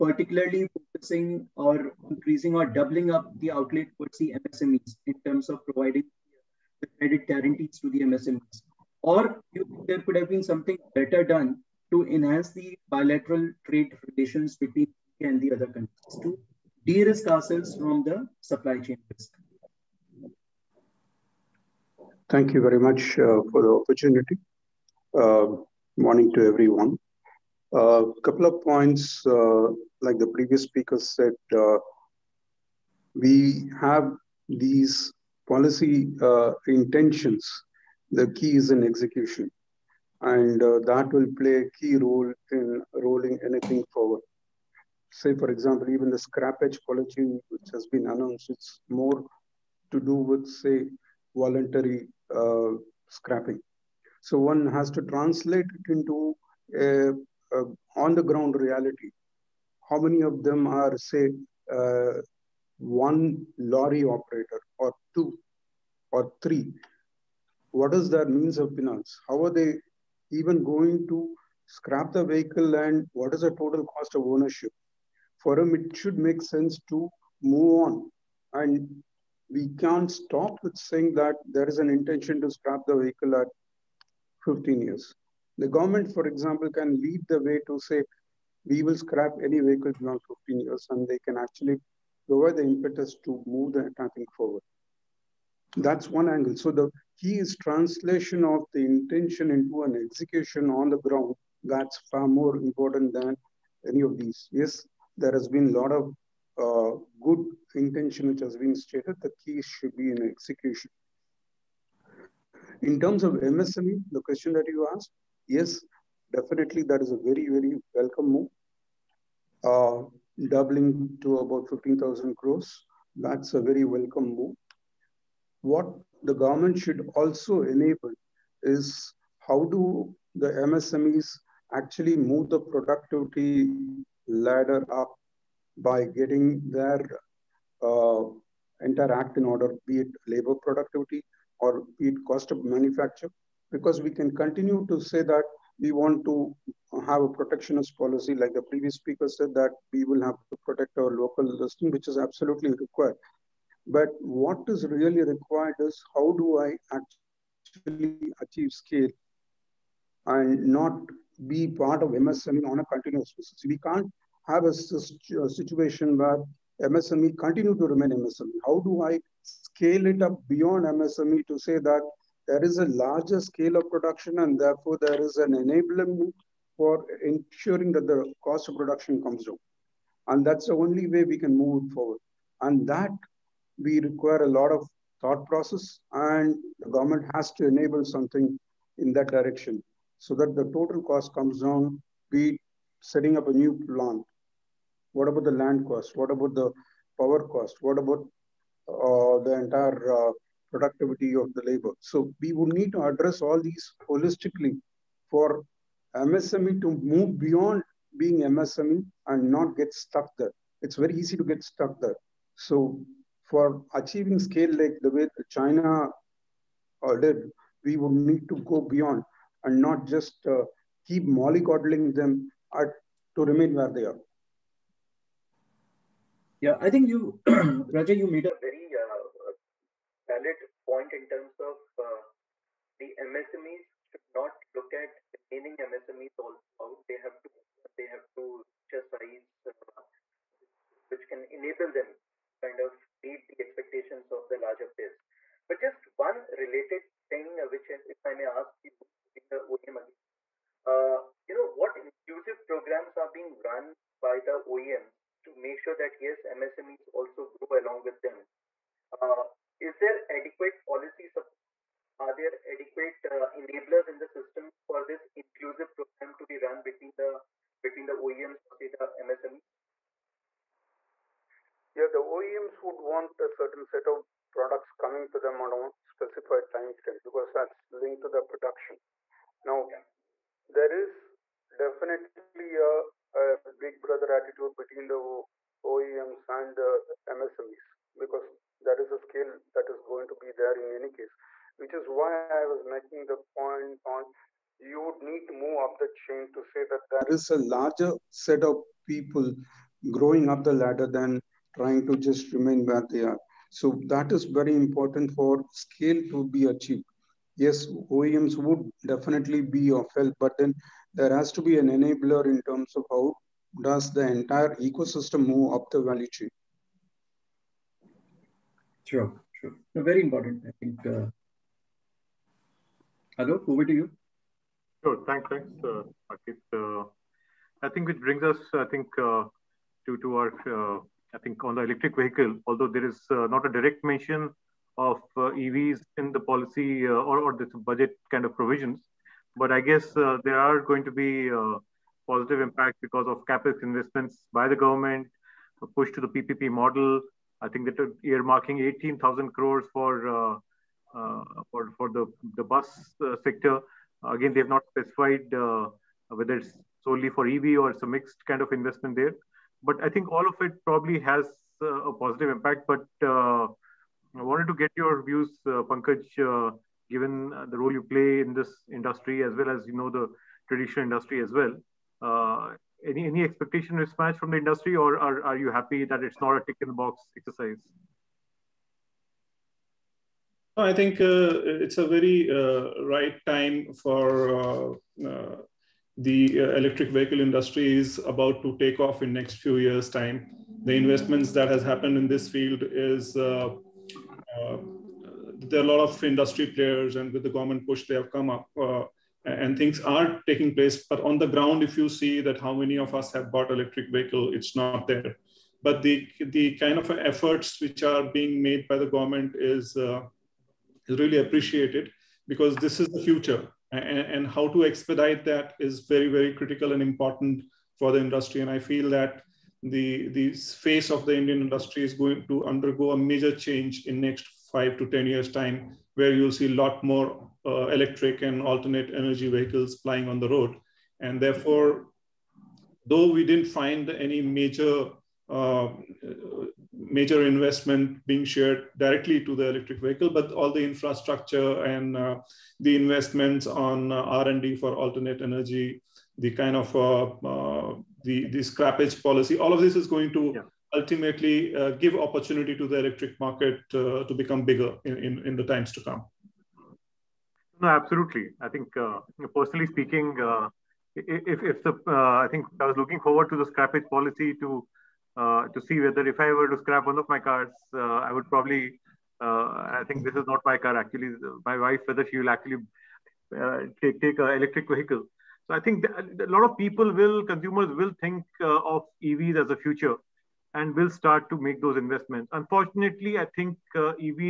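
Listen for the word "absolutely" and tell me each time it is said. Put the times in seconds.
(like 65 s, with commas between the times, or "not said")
152 s, 457 s.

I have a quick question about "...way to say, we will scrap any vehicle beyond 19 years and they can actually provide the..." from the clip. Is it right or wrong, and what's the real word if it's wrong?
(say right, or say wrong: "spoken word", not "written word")
wrong: "15", not "19".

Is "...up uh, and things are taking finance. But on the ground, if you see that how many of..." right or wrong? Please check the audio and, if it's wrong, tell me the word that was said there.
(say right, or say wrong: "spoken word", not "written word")
wrong: "place", not "finance".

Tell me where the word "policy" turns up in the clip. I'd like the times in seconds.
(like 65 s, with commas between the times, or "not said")
35 s, 46 s, 147 s, 260 s, 336 s, 449 s, 464 s.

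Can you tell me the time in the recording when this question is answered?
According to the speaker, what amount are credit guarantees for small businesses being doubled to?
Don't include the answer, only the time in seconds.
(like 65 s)
121 s.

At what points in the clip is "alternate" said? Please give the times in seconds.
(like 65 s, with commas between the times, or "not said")
428 s, 444 s.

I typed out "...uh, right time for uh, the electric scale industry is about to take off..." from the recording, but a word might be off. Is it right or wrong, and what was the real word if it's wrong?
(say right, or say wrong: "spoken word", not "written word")
wrong: "vehicle", not "scale".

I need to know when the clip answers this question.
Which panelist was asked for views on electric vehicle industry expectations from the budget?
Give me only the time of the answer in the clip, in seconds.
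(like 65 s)
365 s.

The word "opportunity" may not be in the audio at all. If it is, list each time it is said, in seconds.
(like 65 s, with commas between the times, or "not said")
23 s, 452 s.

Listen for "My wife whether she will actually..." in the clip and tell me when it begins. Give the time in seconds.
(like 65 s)
471 s.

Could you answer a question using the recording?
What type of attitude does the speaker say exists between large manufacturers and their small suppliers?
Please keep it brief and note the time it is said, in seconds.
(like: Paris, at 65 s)
big brother attitude, at 283 s.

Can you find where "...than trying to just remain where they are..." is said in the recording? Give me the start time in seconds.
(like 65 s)
301 s.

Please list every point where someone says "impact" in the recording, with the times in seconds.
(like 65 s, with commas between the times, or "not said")
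342 s, 362 s.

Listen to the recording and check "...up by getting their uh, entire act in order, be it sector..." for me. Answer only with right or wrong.
wrong.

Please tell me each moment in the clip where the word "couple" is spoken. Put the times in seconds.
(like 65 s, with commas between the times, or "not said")
28 s.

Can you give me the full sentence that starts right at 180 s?
And that's the only way we can move forward.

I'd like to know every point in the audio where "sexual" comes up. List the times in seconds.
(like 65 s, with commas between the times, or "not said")
not said.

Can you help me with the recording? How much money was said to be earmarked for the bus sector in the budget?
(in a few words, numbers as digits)
18,000 crores.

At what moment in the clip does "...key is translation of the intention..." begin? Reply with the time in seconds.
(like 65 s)
97 s.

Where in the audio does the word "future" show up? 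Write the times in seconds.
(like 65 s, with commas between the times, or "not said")
413 s, 479 s.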